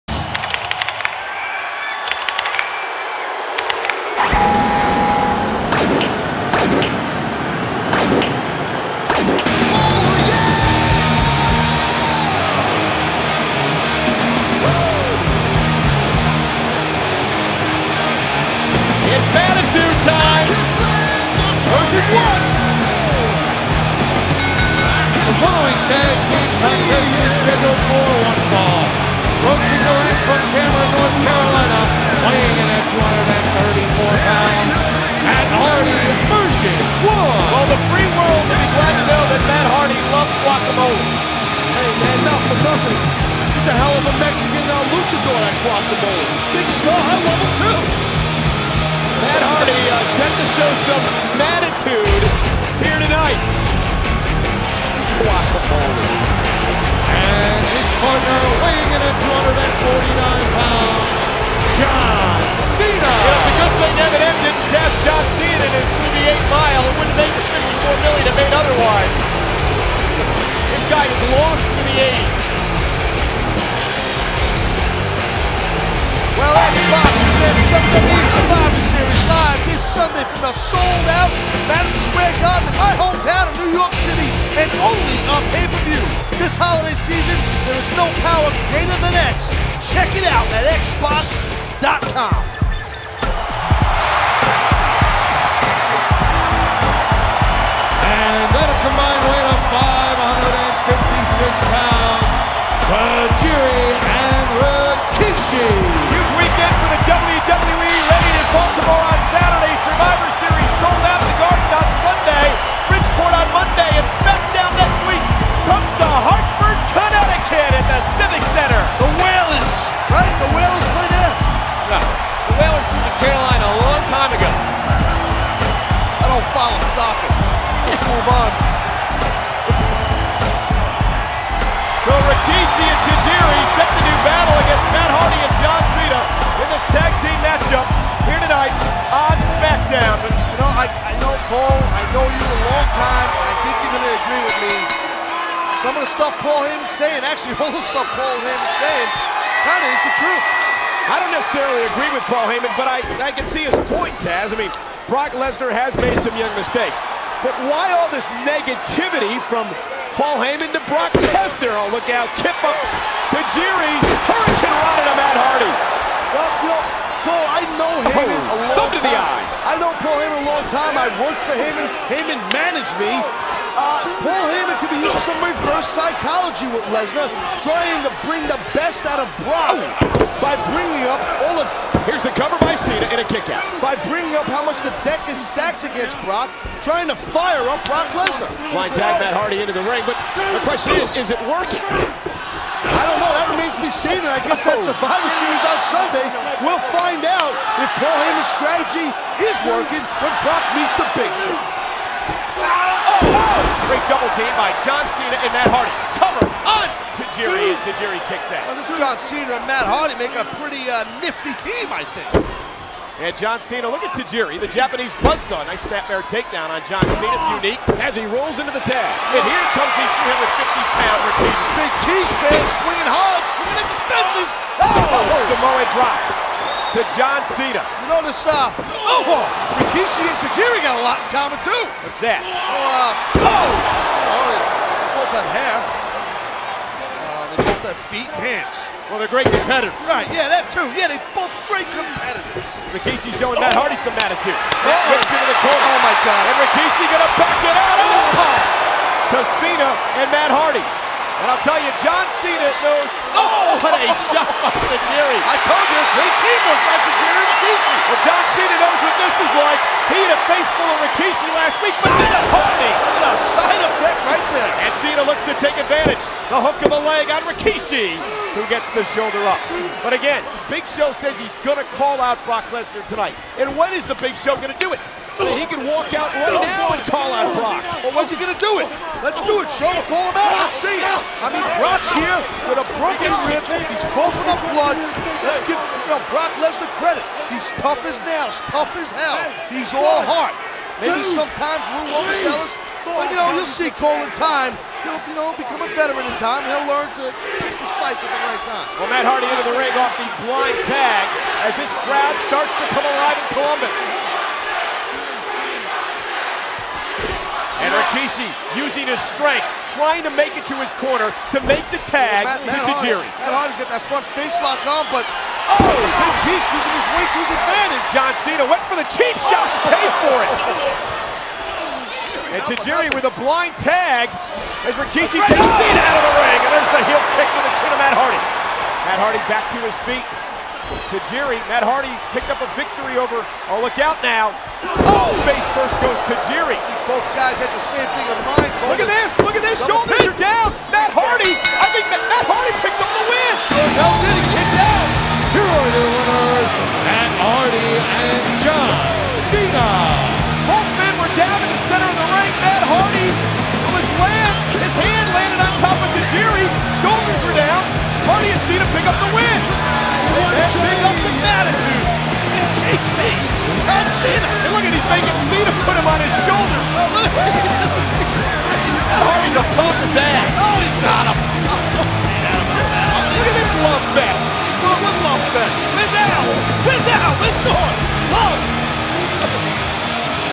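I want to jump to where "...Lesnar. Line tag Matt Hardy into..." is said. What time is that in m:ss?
3:08.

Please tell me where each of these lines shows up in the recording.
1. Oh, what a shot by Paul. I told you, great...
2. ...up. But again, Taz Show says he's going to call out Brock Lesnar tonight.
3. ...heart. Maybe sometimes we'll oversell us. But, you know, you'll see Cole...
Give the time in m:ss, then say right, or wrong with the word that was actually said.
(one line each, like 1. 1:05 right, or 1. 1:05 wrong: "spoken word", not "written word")
1. 4:13 wrong: "Tajiri", not "Paul"
2. 4:29 wrong: "Big", not "Taz"
3. 4:50 right.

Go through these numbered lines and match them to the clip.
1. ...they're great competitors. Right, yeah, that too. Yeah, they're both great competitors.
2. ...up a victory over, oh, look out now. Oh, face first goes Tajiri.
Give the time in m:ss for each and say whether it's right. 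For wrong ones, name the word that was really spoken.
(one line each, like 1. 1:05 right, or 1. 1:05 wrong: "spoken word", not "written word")
1. 3:59 right
2. 5:32 right.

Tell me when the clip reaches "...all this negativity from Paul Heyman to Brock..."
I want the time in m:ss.
2:37.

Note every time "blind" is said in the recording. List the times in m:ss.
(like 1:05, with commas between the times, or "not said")
5:00, 5:23.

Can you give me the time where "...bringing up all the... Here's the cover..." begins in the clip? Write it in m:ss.
3:00.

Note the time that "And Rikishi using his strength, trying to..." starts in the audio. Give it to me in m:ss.
5:07.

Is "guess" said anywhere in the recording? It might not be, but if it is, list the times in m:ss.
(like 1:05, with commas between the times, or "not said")
3:14.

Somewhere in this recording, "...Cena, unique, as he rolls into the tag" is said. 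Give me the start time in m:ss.
3:37.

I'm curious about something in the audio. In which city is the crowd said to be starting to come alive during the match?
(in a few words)
Columbus.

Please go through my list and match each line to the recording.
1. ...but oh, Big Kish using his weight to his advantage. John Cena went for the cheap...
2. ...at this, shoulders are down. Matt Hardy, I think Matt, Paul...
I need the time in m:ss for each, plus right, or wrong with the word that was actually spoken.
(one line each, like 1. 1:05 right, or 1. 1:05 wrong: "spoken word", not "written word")
1. 5:15 right
2. 5:39 wrong: "Matt", not "Paul".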